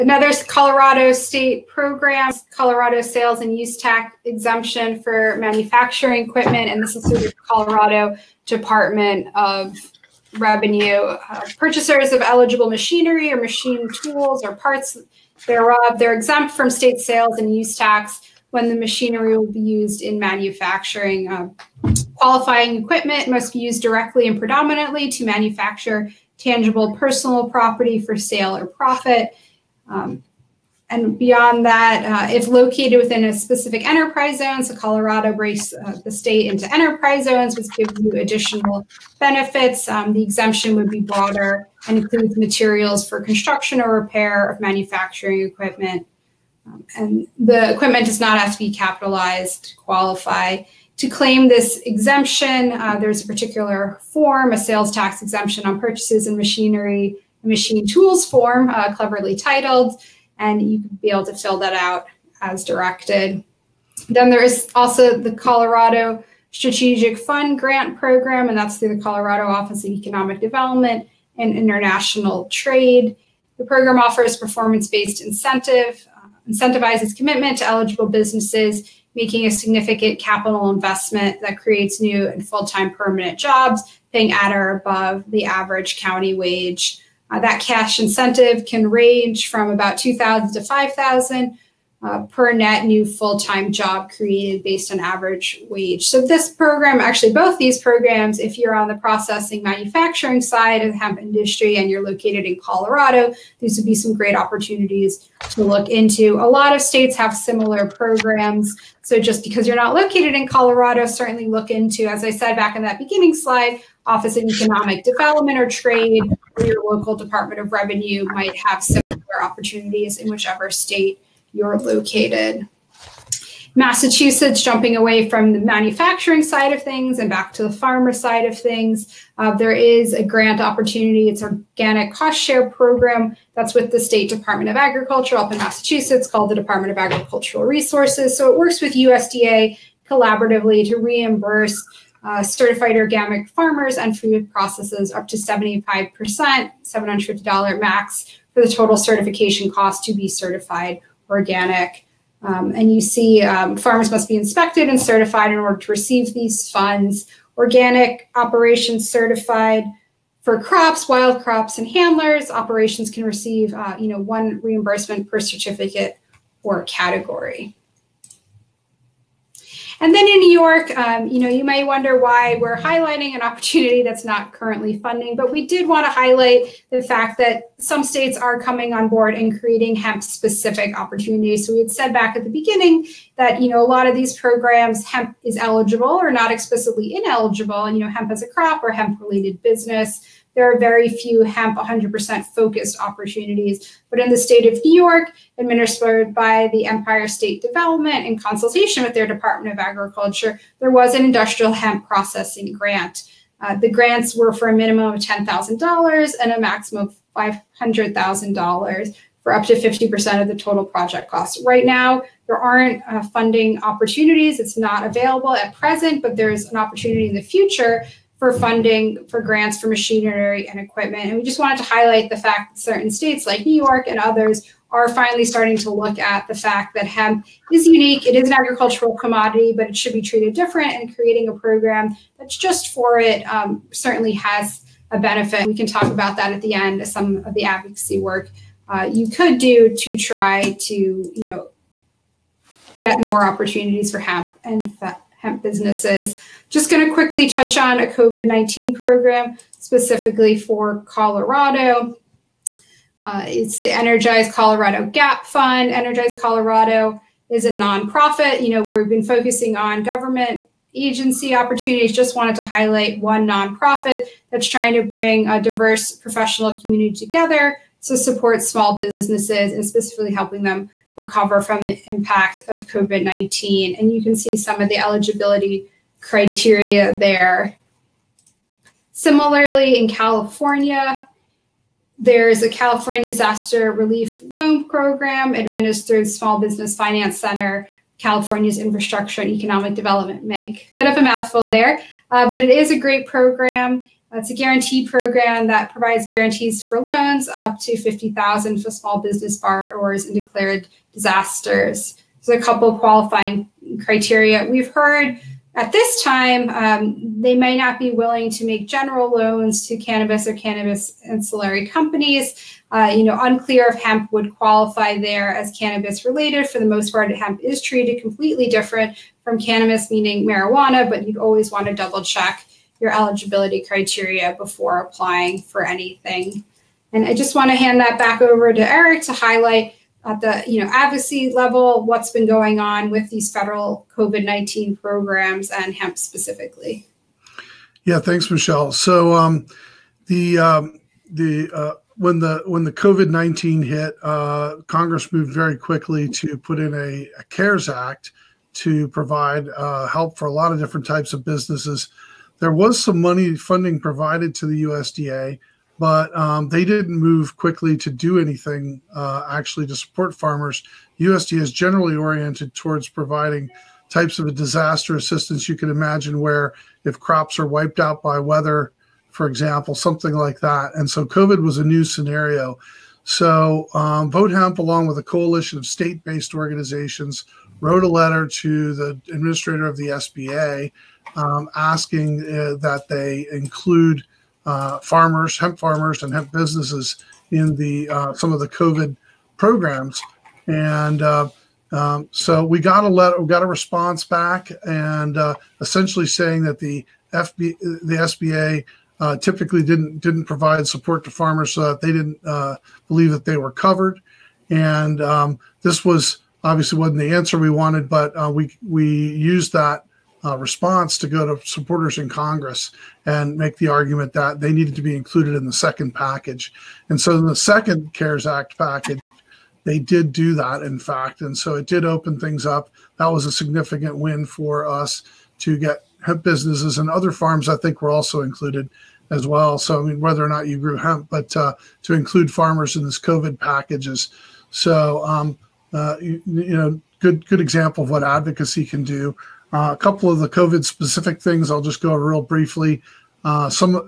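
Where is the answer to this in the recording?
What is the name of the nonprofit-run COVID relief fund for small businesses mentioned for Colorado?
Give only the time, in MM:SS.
04:13.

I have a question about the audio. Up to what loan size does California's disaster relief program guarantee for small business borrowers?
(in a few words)
50,000.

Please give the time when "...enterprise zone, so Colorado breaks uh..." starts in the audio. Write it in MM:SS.
00:33.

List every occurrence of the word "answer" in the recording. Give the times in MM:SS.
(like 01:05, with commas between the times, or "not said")
06:47.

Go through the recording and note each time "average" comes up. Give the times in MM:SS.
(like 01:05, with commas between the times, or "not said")
01:25, 01:34.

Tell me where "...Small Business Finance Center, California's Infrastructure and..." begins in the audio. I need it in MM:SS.
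04:46.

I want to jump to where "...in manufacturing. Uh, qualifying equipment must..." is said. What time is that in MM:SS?
00:20.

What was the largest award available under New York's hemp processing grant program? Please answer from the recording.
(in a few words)
$500,000.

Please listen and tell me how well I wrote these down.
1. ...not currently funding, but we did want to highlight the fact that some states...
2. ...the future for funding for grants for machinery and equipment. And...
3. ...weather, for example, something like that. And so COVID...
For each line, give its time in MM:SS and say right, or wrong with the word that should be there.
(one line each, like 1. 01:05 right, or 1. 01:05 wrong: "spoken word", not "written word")
1. 02:54 right
2. 03:37 right
3. 06:08 right.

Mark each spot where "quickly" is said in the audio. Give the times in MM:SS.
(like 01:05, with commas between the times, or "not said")
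04:07, 05:45, 05:57.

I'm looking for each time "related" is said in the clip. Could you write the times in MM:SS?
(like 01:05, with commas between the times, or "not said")
03:08, 05:16.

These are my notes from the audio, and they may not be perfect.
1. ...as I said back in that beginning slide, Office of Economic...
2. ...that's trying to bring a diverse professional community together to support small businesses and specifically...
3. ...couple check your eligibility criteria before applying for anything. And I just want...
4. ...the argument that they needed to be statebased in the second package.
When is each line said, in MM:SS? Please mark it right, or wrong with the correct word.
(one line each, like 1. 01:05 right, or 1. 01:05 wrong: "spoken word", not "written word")
1. 01:52 right
2. 04:24 right
3. 05:21 wrong: "double", not "couple"
4. 06:53 wrong: "included", not "statebased".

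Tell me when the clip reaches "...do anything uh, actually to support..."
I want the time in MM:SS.
05:58.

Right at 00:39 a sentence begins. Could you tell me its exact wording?
Um, the exemption would be broader and includes materials for construction or repair of manufacturing equipment.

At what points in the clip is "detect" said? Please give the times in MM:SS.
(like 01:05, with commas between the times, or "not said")
not said.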